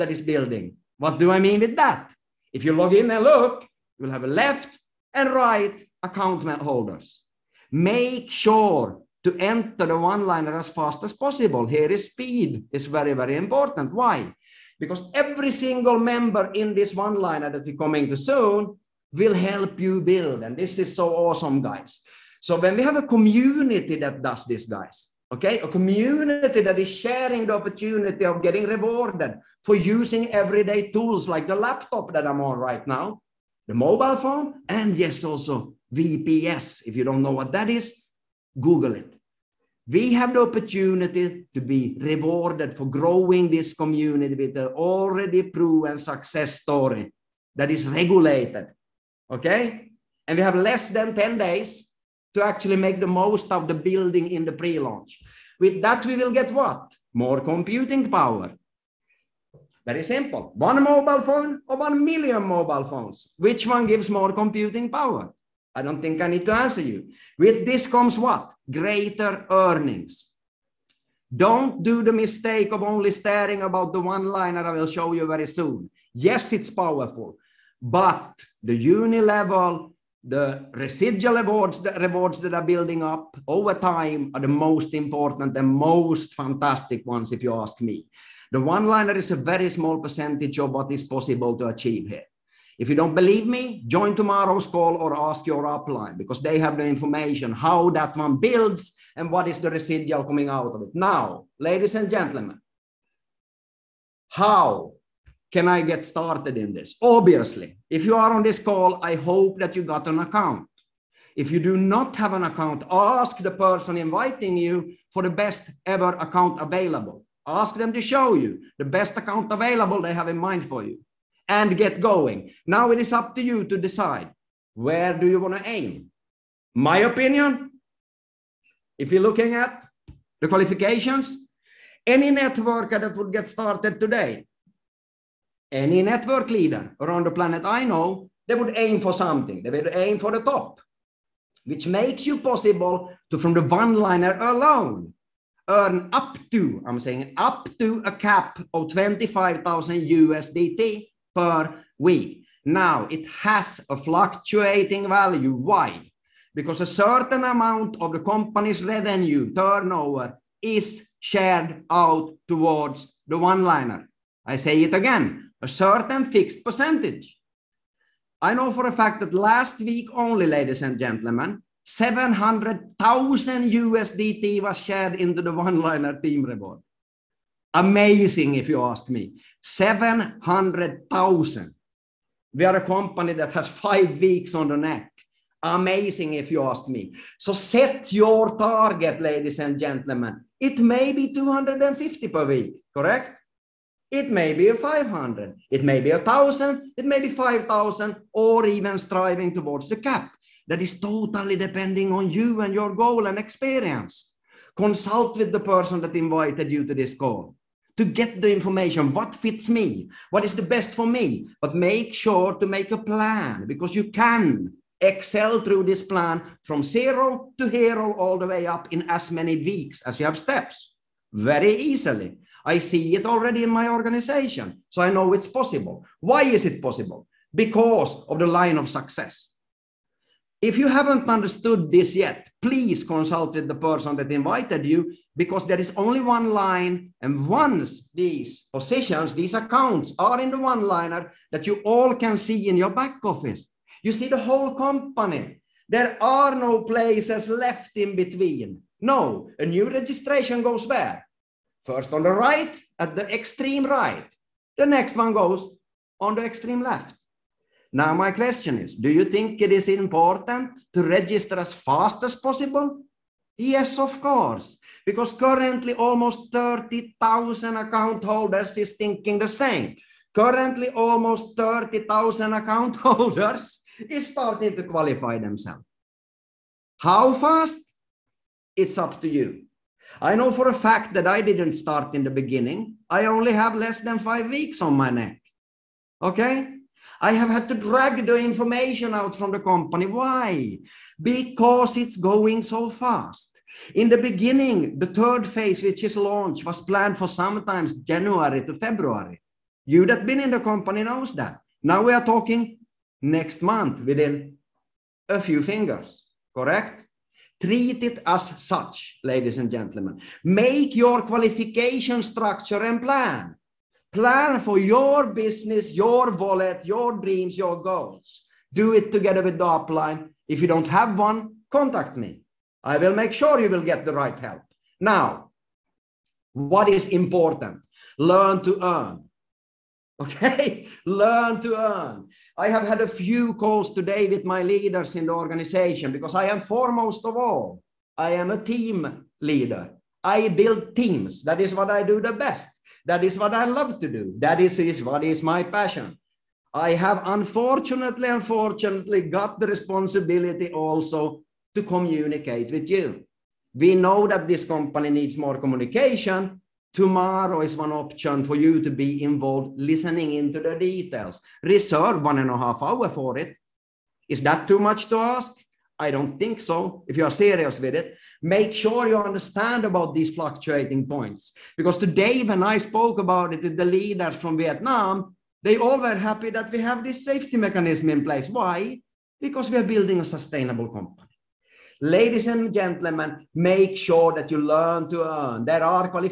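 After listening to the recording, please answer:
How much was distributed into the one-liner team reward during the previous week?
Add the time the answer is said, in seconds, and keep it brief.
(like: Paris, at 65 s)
700,000 USDT, at 171 s.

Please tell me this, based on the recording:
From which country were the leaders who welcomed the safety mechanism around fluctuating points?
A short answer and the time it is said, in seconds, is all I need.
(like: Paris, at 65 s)
Vietnam, at 374 s.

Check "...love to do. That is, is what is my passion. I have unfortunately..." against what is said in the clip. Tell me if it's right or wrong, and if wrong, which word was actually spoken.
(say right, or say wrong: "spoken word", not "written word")
right.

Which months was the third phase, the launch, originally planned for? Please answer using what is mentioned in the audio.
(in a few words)
January to February.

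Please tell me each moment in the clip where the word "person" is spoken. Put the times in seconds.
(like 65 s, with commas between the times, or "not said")
113 s, 205 s, 233 s.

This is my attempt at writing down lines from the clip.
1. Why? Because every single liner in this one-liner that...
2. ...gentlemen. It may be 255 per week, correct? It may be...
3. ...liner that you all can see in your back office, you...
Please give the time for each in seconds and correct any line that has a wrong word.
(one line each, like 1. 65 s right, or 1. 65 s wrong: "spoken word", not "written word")
1. 13 s wrong: "member", not "liner"
2. 189 s wrong: "250", not "255"
3. 240 s right.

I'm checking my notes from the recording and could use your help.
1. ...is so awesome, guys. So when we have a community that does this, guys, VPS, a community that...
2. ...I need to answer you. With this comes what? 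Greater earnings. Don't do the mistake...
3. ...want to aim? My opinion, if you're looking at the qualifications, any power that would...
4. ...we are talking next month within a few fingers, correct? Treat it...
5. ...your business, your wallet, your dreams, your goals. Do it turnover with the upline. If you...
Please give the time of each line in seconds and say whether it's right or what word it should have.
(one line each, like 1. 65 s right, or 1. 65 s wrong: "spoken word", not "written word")
1. 20 s wrong: "Okay", not "VPS"
2. 66 s right
3. 125 s wrong: "networker", not "power"
4. 302 s right
5. 314 s wrong: "together", not "turnover".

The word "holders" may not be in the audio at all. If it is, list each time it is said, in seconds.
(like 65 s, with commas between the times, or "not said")
6 s, 268 s, 273 s.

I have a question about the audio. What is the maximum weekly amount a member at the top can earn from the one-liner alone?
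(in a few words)
25,000 USDT.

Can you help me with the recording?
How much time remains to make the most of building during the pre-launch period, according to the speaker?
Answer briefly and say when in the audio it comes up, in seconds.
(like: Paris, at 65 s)
less than 10 days, at 50 s.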